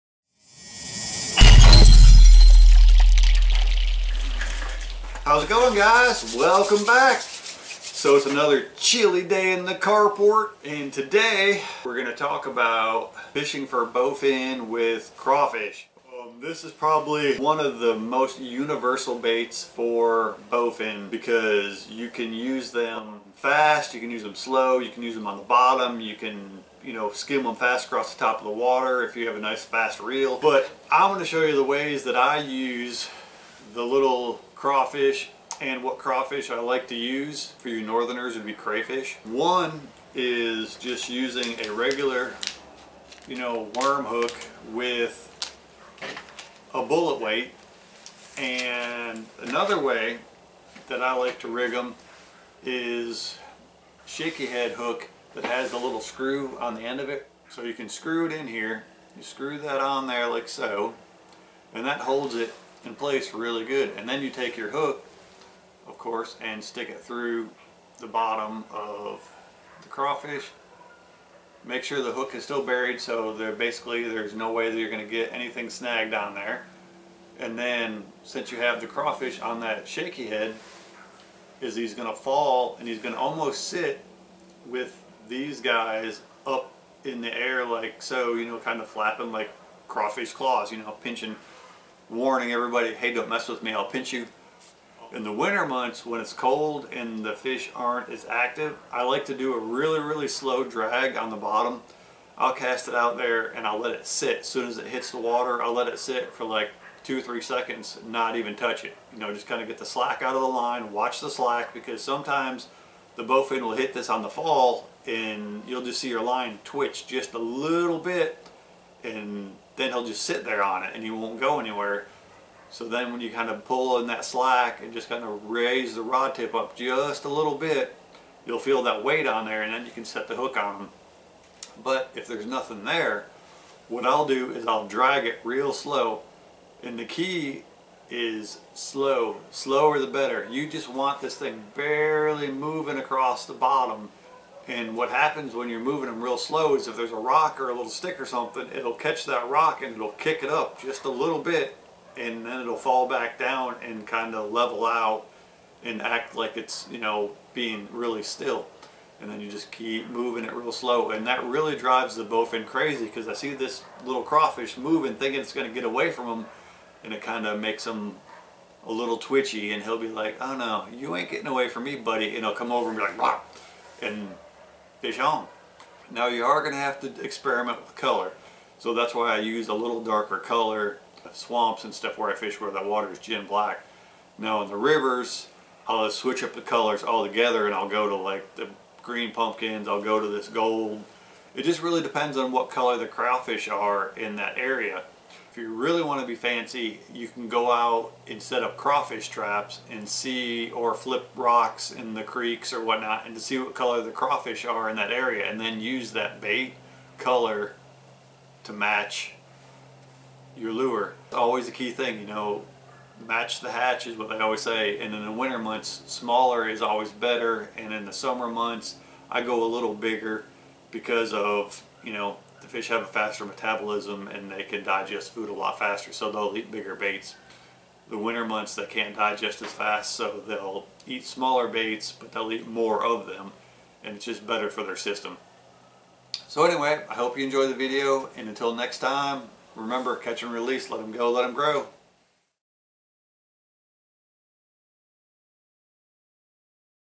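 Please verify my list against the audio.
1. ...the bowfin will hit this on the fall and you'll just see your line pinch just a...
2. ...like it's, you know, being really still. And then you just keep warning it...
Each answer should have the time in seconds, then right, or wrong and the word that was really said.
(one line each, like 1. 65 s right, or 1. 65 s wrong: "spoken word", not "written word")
1. 113 s wrong: "twitch", not "pinch"
2. 156 s wrong: "moving", not "warning".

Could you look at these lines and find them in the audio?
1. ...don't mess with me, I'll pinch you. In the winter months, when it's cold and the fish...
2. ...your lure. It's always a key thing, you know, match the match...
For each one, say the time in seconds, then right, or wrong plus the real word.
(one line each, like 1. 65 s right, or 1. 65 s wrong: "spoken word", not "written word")
1. 93 s right
2. 210 s wrong: "hatch", not "match".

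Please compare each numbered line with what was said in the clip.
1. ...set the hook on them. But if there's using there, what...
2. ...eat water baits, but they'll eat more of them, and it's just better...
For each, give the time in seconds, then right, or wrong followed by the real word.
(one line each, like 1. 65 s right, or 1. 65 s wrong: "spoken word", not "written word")
1. 130 s wrong: "nothing", not "using"
2. 231 s wrong: "smaller", not "water".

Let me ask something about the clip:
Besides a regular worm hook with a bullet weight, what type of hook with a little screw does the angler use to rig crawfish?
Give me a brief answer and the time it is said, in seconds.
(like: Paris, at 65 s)
Shaky head hook, at 54 s.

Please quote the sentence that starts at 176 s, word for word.
Now you are going to have to experiment with color.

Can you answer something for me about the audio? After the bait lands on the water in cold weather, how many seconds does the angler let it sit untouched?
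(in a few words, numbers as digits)
2 or 3.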